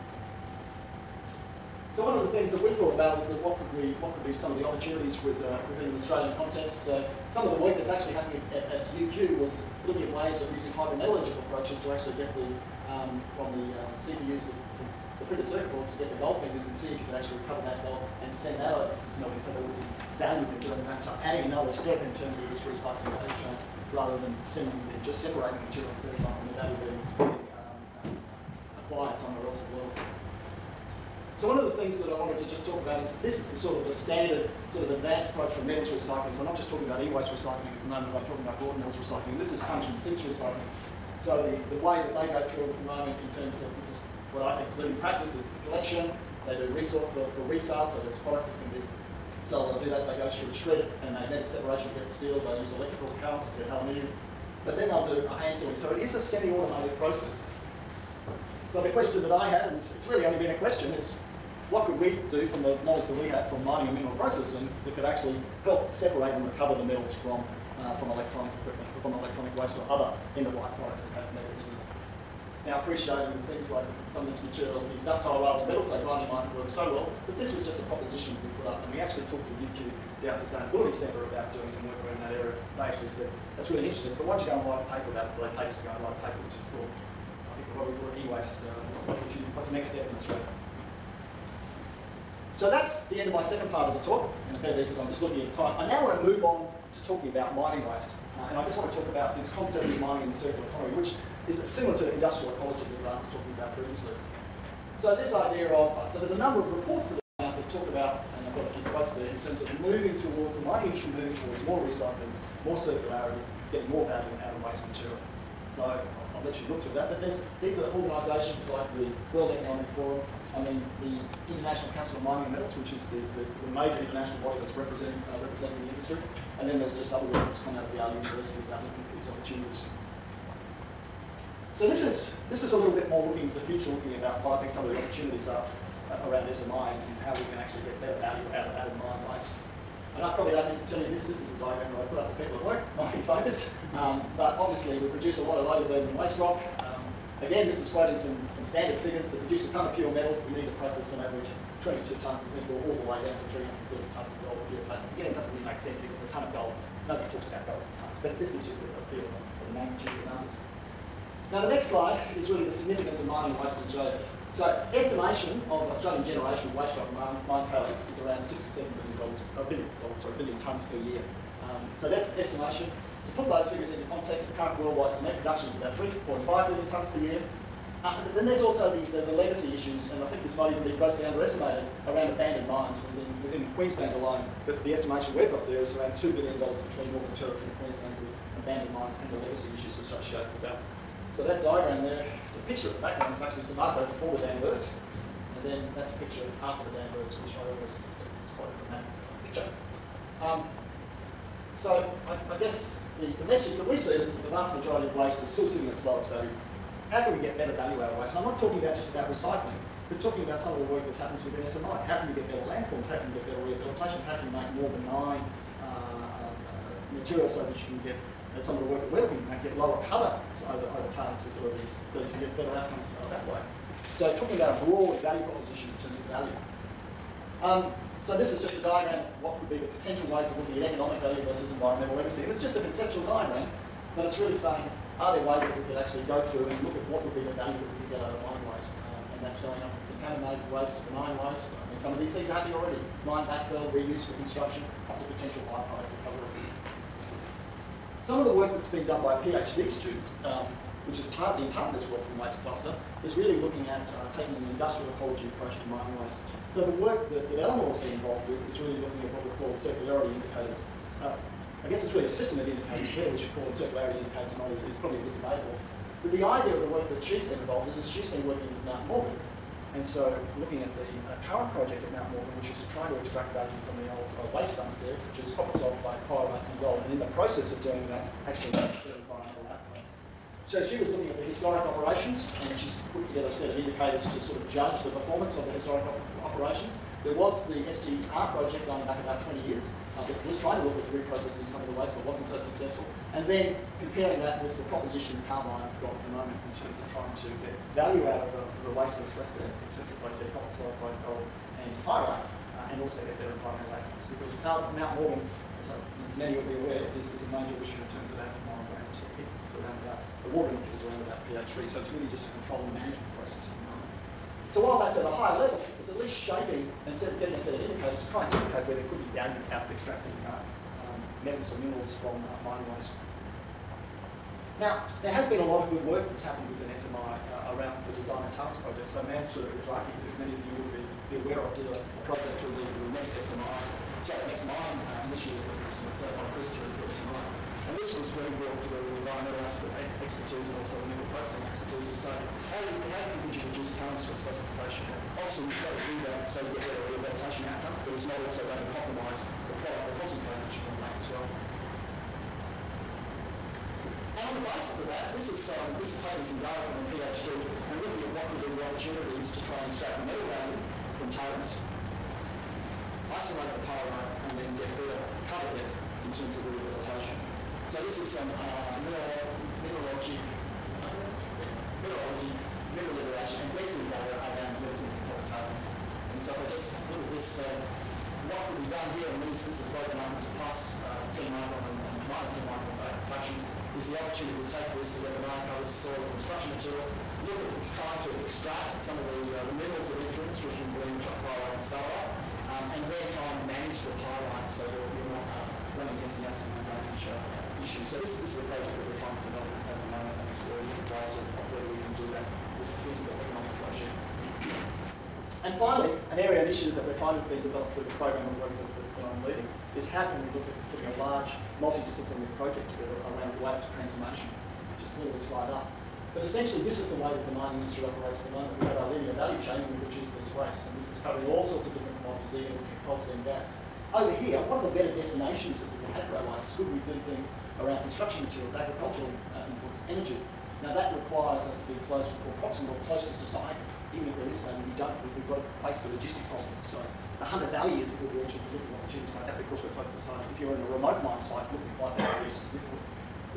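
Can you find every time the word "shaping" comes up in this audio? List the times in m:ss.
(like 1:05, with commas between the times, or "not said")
5:16.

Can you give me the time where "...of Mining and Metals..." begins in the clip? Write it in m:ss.
2:02.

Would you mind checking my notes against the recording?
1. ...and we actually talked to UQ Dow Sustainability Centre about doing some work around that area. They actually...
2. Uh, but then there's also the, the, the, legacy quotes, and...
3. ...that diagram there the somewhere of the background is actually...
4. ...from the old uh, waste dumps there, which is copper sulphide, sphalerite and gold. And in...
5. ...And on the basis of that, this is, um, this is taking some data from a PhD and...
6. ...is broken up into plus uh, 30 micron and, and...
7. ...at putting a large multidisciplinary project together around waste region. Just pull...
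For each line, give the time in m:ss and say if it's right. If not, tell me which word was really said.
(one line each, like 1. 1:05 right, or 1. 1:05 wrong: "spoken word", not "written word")
1. 1:18 right
2. 2:58 wrong: "issues", not "quotes"
3. 3:11 wrong: "picture", not "somewhere"
4. 4:33 wrong: "pyrite", not "sphalerite"
5. 5:54 right
6. 6:19 wrong: "10", not "30"
7. 6:50 wrong: "transformation", not "region".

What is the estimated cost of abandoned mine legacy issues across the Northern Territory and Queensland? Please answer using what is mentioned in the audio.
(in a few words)
$2 billion.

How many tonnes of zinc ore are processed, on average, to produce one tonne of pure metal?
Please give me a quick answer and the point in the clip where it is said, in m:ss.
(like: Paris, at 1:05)
22, at 2:31.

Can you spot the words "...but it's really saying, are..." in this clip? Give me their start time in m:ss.
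3:54.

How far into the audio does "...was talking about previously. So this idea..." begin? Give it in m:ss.
1:43.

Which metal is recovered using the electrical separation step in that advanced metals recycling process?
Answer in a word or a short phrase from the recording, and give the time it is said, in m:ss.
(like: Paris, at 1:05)
aluminium, at 0:53.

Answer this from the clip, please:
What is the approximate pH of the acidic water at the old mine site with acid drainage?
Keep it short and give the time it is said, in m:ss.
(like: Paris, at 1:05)
3, at 5:11.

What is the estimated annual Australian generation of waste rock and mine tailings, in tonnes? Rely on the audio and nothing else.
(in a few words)
6 to 7 billion tonnes.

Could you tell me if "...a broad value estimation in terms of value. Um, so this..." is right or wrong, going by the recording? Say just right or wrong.
wrong.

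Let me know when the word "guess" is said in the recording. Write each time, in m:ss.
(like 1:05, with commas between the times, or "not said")
3:22, 4:21.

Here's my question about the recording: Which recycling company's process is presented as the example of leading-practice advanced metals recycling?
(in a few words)
Sims recycling.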